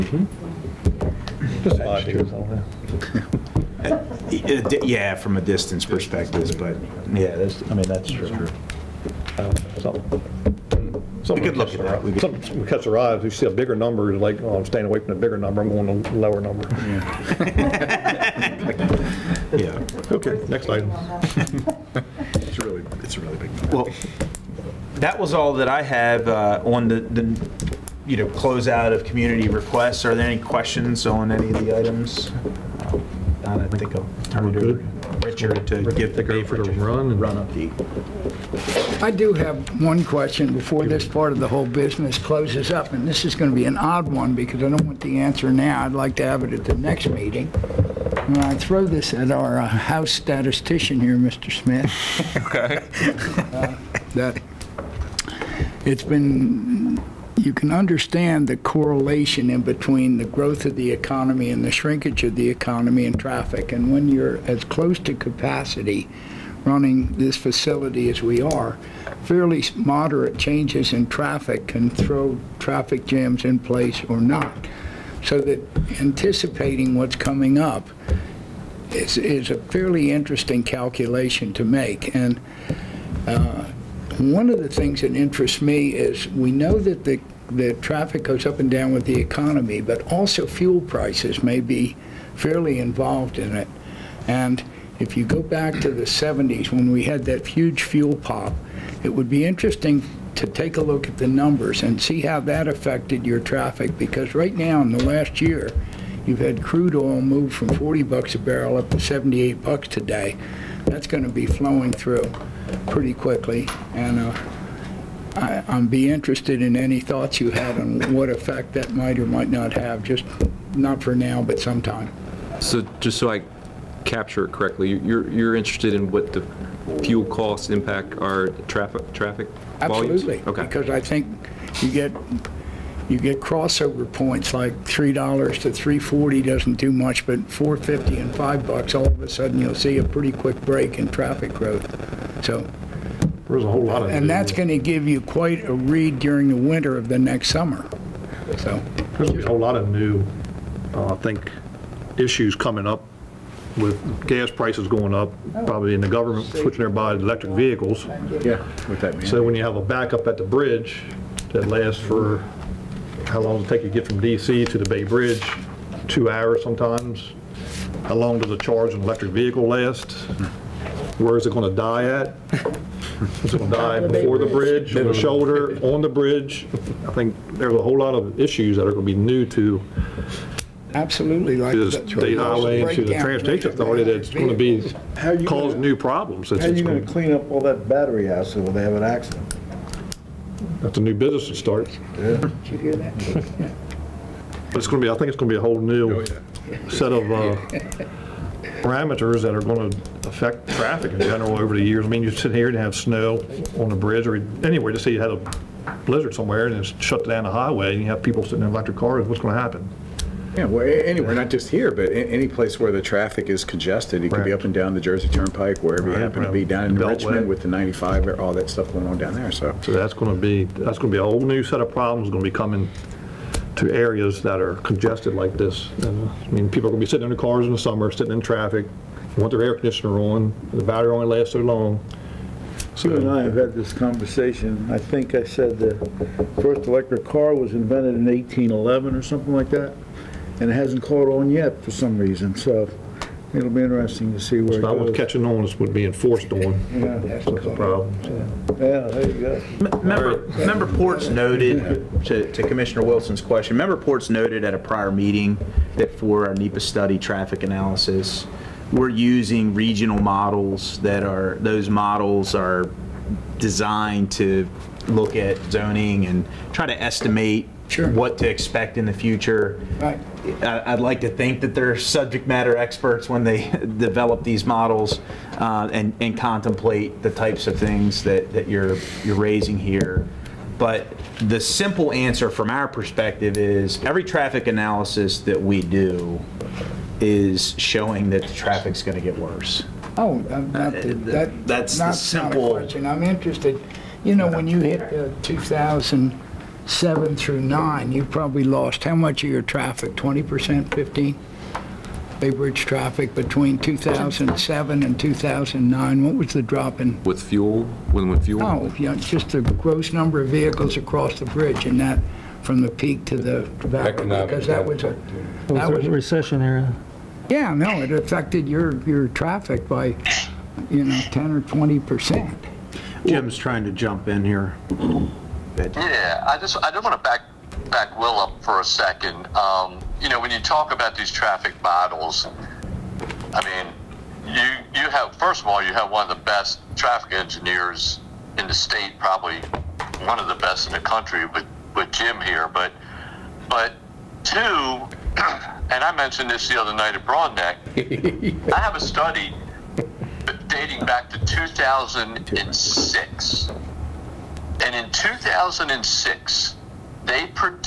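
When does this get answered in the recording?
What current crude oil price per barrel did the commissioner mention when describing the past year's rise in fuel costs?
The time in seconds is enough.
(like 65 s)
108 s.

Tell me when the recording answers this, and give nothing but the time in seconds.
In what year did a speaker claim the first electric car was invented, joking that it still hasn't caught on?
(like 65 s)
238 s.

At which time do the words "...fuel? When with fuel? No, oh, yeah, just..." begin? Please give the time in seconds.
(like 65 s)
307 s.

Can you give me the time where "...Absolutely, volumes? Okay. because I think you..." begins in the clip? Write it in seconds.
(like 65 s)
129 s.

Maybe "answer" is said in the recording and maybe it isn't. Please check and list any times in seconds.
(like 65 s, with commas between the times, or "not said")
45 s, 282 s.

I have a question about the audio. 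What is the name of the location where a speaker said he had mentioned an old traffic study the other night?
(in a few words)
Broadneck.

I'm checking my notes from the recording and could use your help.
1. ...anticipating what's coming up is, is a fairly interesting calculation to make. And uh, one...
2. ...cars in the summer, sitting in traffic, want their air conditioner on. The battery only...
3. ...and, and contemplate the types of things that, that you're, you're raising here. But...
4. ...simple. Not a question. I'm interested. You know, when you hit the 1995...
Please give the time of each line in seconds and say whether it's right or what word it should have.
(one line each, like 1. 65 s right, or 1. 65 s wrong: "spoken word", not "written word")
1. 76 s right
2. 227 s right
3. 275 s right
4. 292 s wrong: "2000", not "1995".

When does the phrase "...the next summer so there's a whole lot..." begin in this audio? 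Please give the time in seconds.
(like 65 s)
147 s.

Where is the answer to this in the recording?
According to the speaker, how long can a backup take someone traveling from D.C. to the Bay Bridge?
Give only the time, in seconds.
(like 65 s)
166 s.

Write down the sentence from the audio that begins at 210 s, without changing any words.
Yeah, well, anywhere, not just here, but any place where the traffic is congested.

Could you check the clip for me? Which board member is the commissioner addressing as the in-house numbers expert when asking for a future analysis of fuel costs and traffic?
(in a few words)
Mr. Smith.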